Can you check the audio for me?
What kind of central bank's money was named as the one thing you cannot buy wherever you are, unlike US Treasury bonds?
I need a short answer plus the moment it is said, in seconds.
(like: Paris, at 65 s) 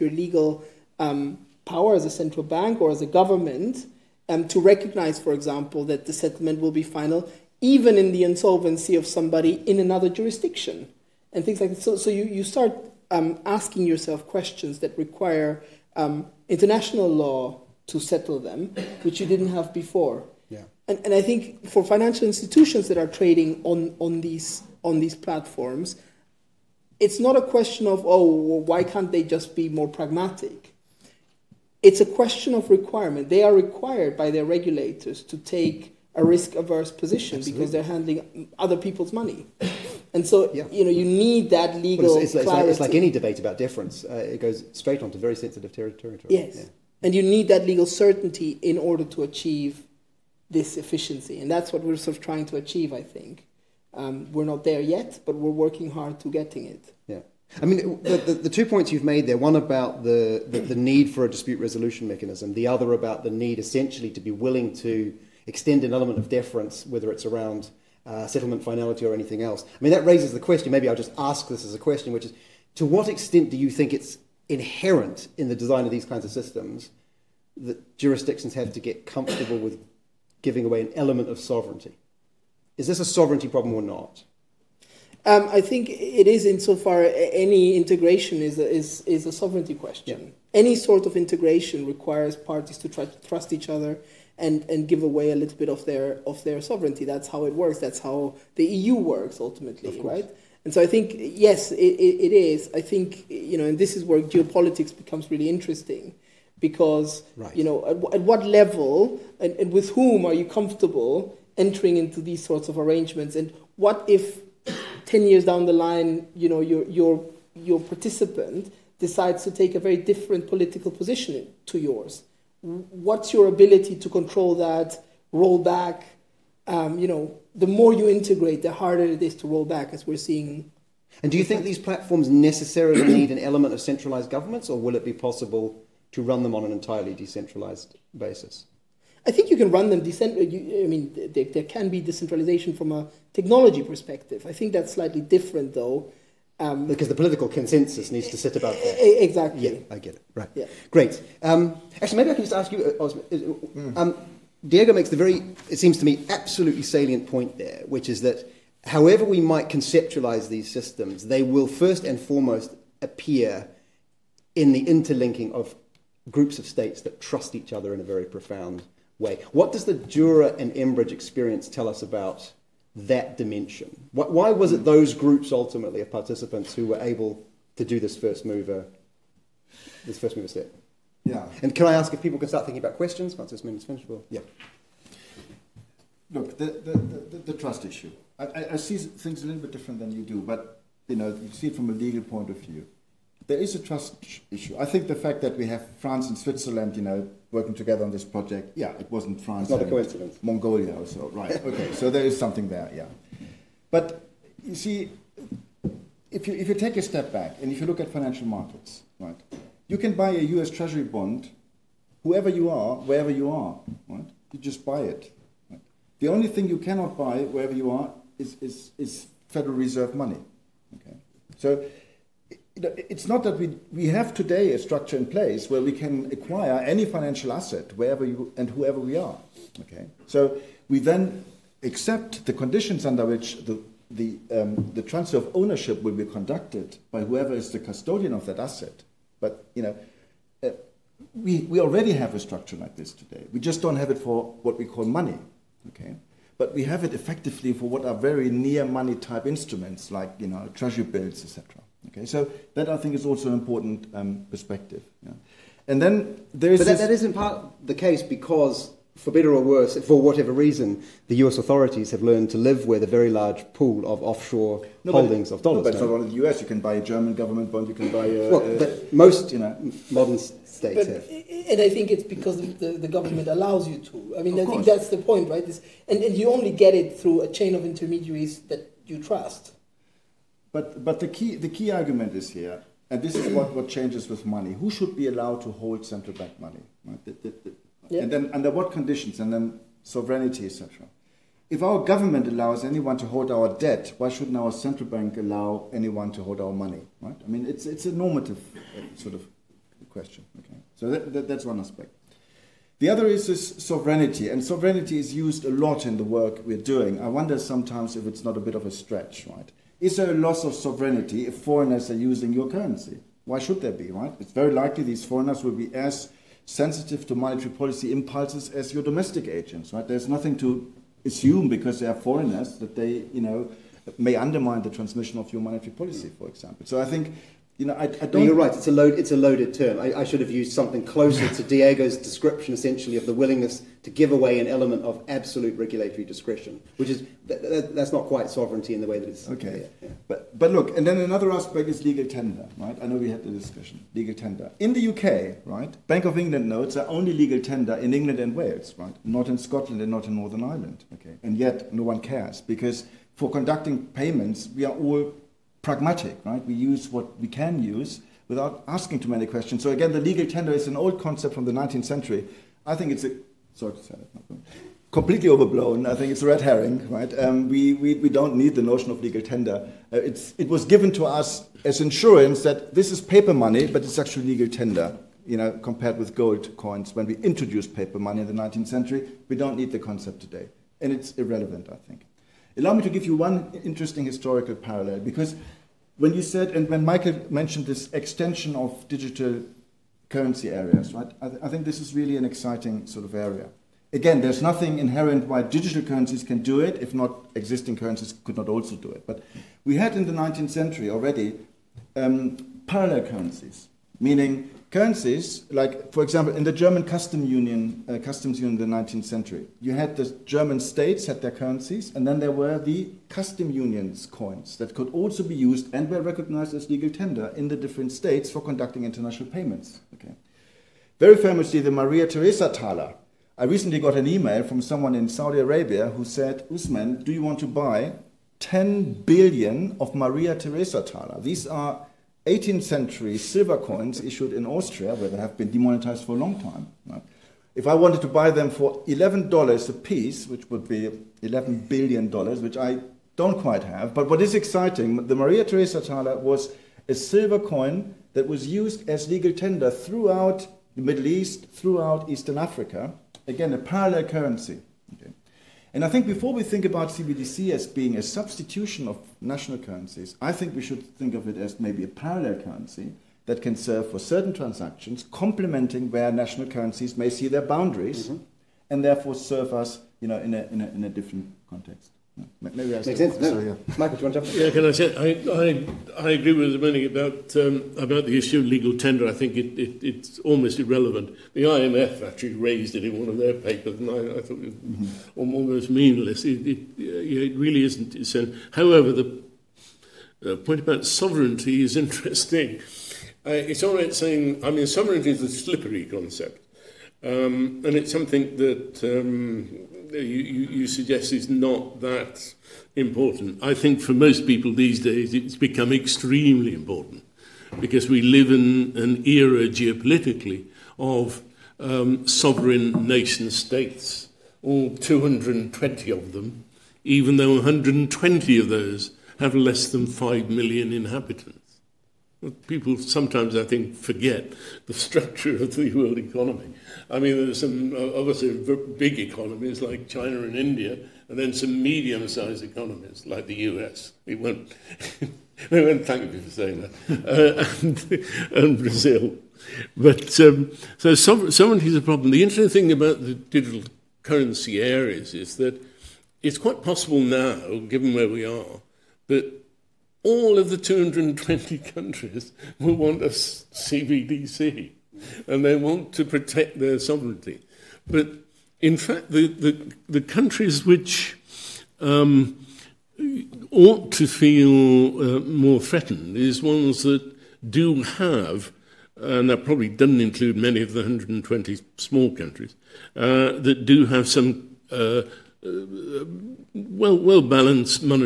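Federal Reserve, at 219 s.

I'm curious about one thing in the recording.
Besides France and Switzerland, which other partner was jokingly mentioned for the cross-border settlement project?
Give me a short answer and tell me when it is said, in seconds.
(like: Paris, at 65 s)
Mongolia, at 200 s.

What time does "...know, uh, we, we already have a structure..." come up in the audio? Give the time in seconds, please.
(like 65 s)
239 s.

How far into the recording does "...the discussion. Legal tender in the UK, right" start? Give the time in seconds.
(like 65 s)
343 s.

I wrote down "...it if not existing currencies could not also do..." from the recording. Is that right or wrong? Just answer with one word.
right.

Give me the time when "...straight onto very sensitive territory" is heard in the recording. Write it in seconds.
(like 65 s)
44 s.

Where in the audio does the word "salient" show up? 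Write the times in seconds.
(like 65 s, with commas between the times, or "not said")
156 s.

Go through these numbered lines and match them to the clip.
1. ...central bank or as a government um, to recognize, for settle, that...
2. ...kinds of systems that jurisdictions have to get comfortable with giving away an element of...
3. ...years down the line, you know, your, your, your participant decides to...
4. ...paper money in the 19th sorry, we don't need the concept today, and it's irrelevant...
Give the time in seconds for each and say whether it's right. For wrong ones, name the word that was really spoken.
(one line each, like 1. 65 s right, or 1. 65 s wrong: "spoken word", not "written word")
1. 2 s wrong: "example", not "settle"
2. 76 s right
3. 115 s right
4. 377 s wrong: "century", not "sorry".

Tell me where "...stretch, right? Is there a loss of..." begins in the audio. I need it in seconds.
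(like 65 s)
308 s.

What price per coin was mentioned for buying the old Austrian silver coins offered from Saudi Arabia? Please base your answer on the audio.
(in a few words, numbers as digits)
$11.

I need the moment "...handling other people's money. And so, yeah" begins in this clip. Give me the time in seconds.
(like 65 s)
37 s.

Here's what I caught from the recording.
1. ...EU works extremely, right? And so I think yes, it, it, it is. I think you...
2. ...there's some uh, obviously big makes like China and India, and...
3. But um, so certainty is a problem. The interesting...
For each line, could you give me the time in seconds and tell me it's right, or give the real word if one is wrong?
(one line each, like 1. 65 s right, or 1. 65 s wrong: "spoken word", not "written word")
1. 98 s wrong: "ultimately", not "extremely"
2. 527 s wrong: "economies", not "makes"
3. 539 s wrong: "sovereignty", not "certainty".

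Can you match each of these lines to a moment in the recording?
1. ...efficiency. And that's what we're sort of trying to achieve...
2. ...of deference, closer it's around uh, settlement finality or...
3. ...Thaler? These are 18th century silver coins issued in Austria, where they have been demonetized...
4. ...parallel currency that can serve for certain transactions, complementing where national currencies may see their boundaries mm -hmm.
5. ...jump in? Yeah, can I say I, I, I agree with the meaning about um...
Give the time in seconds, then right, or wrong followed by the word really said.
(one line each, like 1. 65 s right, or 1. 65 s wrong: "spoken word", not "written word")
1. 50 s right
2. 66 s wrong: "whether", not "closer"
3. 431 s right
4. 462 s right
5. 474 s right.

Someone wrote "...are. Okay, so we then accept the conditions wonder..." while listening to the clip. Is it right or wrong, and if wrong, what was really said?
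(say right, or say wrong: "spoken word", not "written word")
wrong: "under", not "wonder".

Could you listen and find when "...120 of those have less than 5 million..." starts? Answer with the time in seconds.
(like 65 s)
517 s.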